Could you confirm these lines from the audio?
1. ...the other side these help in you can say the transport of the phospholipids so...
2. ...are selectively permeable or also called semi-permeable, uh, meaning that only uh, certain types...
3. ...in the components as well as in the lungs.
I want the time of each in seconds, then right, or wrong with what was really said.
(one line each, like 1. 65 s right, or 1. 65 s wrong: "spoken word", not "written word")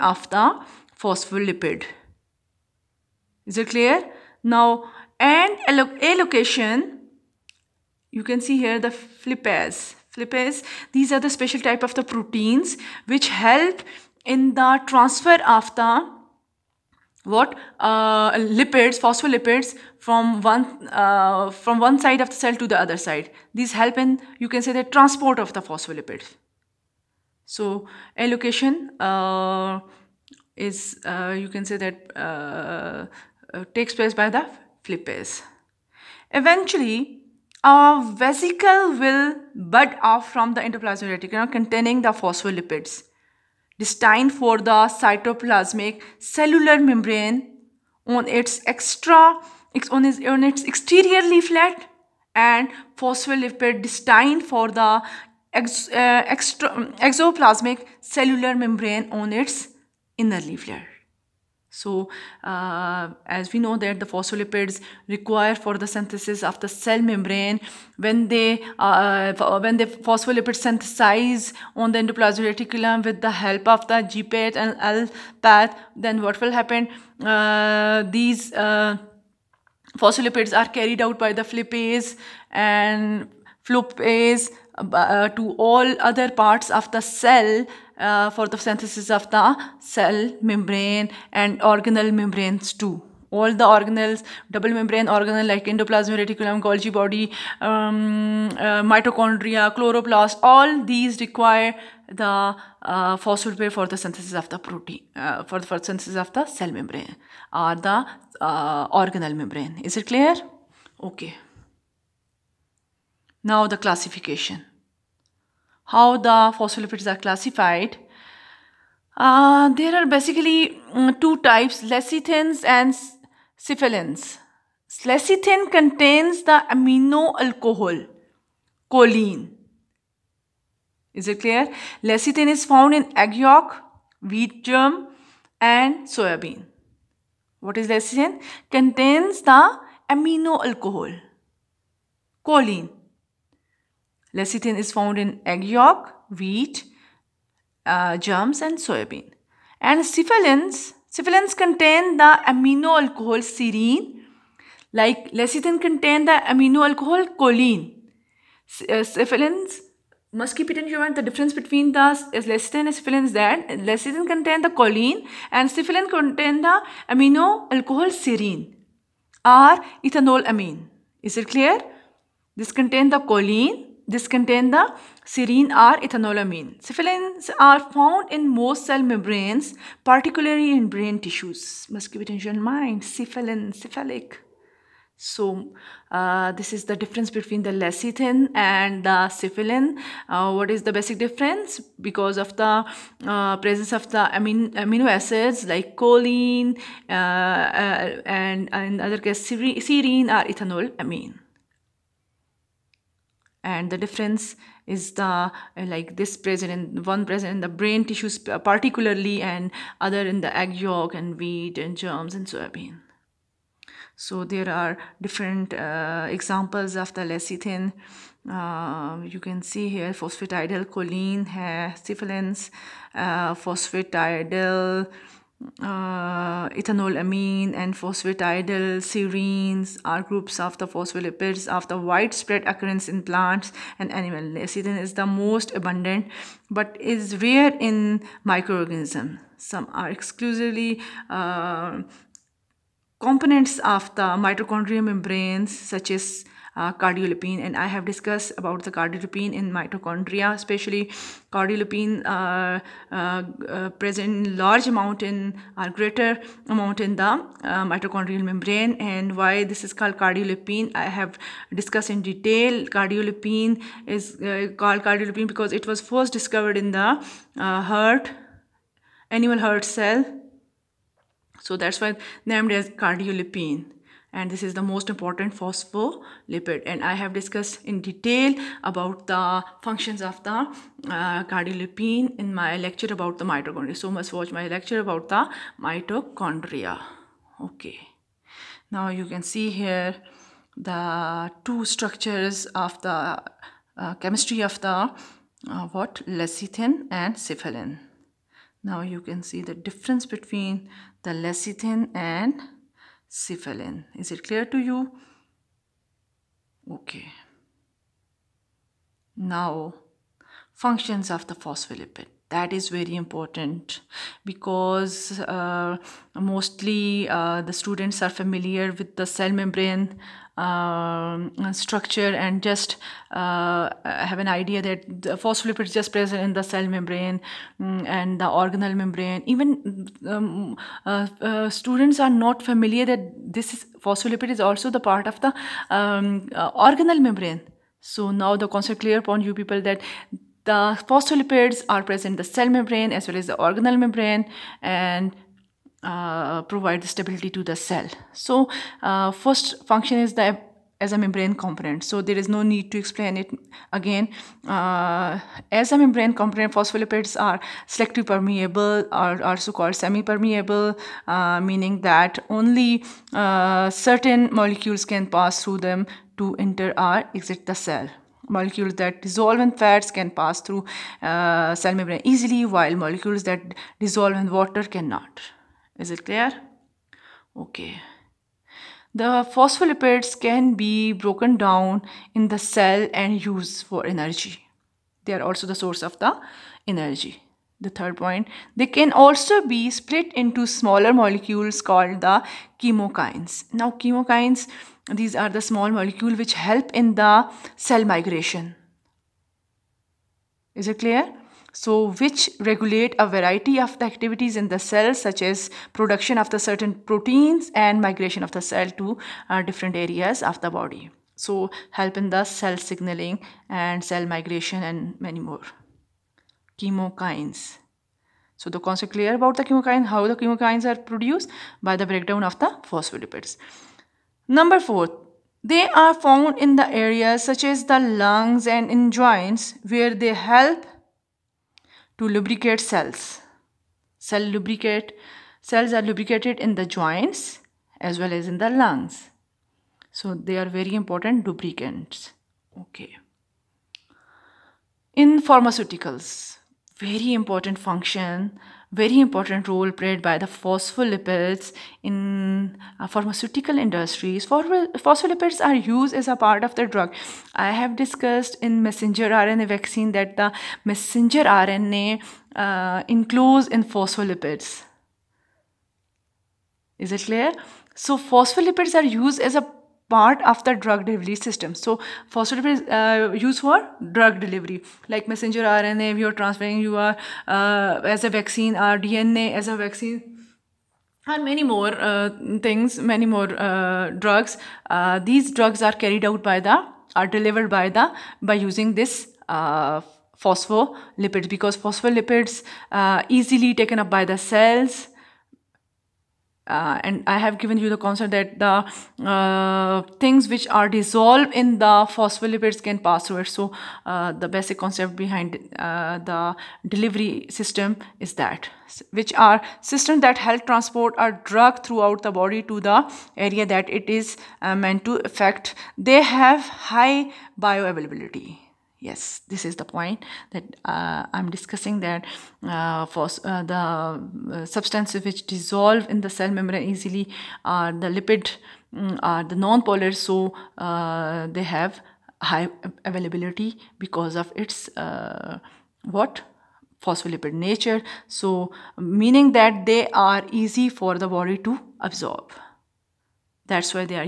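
1. 22 s right
2. 357 s wrong: "molecules", not "types"
3. 436 s wrong: "joints", not "components".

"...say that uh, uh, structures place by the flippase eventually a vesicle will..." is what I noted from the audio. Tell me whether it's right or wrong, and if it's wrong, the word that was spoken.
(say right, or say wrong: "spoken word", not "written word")
wrong: "takes", not "structures".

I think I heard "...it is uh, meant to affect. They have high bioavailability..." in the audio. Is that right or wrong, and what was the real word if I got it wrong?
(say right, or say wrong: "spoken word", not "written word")
right.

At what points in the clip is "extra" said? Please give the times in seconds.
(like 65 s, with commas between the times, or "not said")
48 s, 56 s.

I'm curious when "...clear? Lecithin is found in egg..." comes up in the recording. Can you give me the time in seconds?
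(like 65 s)
131 s.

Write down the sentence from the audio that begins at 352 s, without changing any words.
So there is no need to explain it again.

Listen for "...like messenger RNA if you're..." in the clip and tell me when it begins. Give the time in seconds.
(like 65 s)
475 s.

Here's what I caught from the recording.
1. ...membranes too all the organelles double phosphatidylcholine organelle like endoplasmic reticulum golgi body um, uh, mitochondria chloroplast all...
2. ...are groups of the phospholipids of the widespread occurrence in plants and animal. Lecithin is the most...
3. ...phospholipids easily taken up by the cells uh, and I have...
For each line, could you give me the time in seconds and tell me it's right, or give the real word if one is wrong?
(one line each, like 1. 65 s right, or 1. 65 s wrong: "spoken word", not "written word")
1. 92 s wrong: "membrane", not "phosphatidylcholine"
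2. 230 s right
3. 491 s right.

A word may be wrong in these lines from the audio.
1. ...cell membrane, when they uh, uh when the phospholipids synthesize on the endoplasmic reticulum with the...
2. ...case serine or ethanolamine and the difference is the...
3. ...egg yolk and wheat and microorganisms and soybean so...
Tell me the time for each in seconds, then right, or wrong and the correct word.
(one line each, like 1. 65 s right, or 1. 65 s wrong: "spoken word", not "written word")
1. 66 s right
2. 199 s right
3. 210 s wrong: "germs", not "microorganisms".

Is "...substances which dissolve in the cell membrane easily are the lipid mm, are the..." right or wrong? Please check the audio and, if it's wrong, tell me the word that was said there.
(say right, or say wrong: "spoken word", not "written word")
right.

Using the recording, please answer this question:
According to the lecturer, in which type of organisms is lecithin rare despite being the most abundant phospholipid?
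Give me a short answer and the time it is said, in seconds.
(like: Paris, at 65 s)
Microorganisms, at 238 s.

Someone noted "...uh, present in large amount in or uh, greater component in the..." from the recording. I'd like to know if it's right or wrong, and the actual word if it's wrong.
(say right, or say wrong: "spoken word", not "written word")
wrong: "amount", not "component".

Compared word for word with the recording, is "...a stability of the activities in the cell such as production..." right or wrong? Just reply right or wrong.
wrong.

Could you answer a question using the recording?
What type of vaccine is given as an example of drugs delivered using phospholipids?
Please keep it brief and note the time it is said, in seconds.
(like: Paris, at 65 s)
Messenger RNA vaccine, at 458 s.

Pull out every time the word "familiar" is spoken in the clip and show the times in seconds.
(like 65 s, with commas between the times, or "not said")
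318 s, 332 s.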